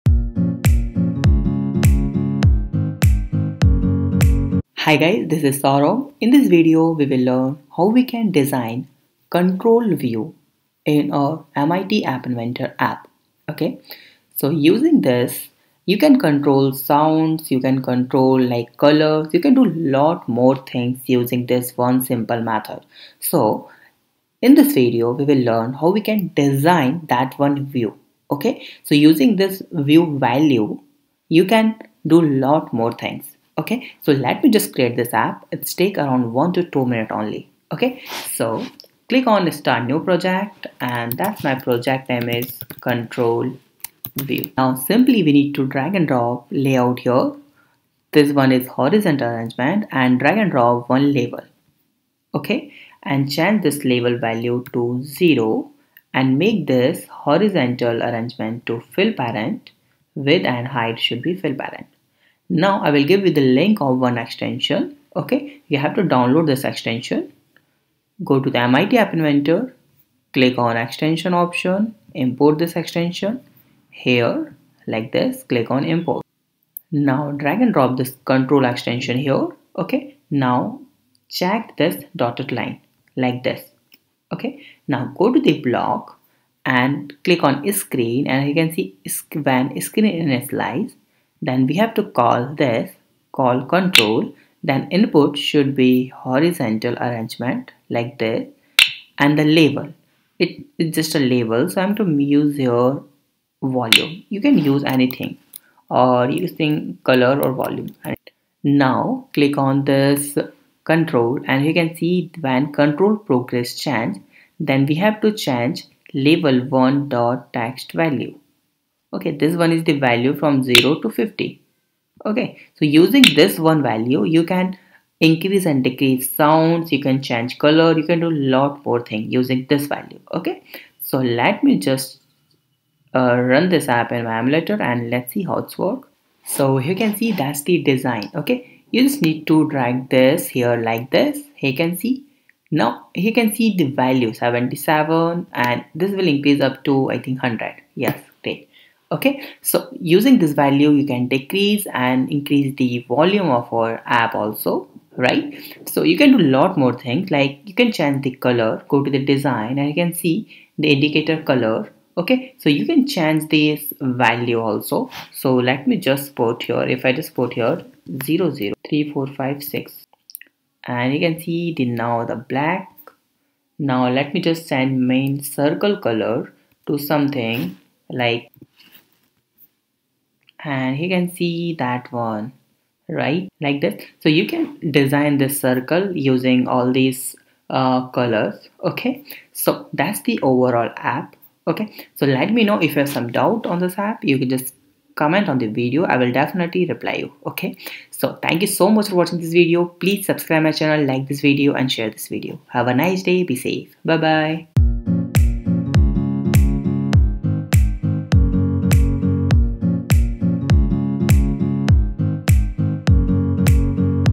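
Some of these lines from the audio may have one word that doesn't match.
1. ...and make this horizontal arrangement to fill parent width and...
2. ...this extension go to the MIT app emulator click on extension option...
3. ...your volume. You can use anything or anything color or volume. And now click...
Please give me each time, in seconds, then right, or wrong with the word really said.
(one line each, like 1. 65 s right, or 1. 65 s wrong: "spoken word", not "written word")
1. 56 s right
2. 66 s wrong: "inventor", not "emulator"
3. 102 s wrong: "using", not "anything".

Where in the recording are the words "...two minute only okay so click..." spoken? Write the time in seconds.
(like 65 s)
36 s.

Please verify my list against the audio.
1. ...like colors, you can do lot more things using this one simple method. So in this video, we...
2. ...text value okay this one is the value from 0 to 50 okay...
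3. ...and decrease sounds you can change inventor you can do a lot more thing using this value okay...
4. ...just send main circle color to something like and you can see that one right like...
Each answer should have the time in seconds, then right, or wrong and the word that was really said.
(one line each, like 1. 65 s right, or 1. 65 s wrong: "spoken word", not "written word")
1. 18 s right
2. 117 s right
3. 125 s wrong: "color", not "inventor"
4. 174 s right.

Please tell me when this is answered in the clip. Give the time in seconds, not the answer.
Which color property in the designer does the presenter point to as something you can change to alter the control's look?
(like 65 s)
160 s.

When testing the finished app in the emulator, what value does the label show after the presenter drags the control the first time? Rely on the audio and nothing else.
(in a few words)
77.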